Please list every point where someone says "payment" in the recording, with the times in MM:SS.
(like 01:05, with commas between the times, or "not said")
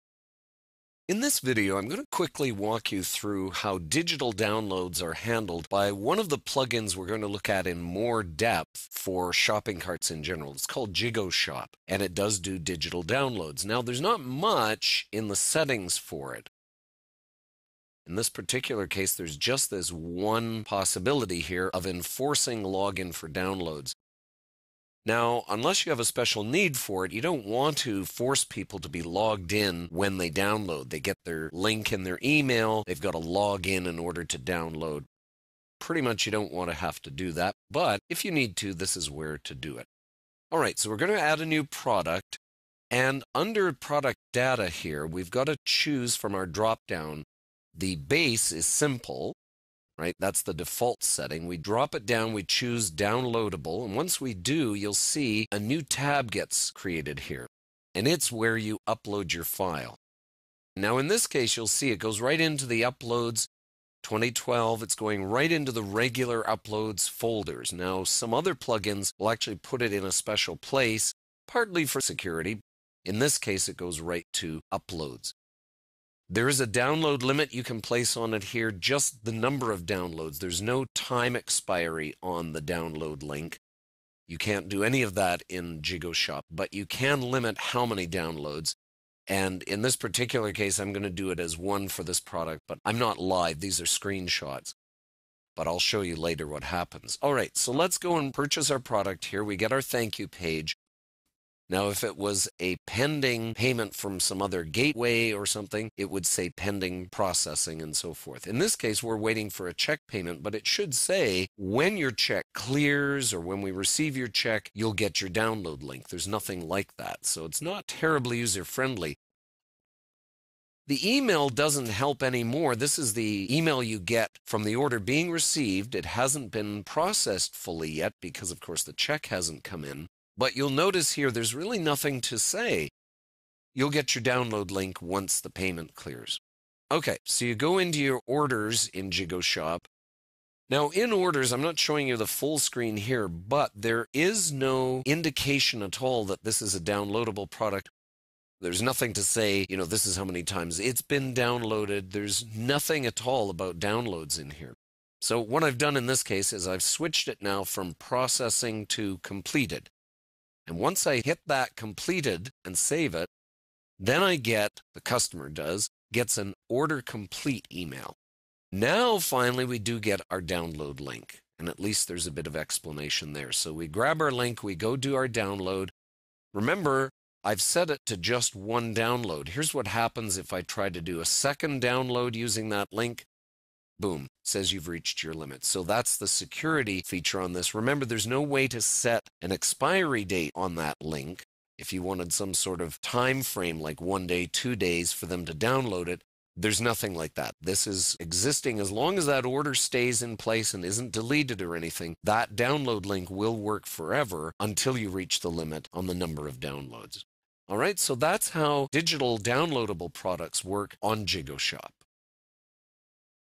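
01:43, 01:50, 02:15.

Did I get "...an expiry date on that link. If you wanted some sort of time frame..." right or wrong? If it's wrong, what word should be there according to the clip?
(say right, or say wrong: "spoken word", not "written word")
right.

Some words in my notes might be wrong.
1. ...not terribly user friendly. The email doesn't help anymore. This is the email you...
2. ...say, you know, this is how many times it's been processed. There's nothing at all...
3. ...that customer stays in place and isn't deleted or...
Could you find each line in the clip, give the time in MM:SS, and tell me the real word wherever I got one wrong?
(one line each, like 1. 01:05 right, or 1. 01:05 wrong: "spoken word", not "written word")
1. 01:57 right
2. 02:29 wrong: "downloaded", not "processed"
3. 03:19 wrong: "order", not "customer".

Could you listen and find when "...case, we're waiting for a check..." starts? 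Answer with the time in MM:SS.
01:48.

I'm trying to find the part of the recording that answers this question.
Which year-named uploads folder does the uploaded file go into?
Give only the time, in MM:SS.
01:02.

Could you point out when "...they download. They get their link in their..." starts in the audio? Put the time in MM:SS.
00:30.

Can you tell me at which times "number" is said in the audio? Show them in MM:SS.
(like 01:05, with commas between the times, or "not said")
01:19, 03:26.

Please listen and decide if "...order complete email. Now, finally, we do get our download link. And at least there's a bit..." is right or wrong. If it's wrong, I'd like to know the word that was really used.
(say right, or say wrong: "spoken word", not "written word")
right.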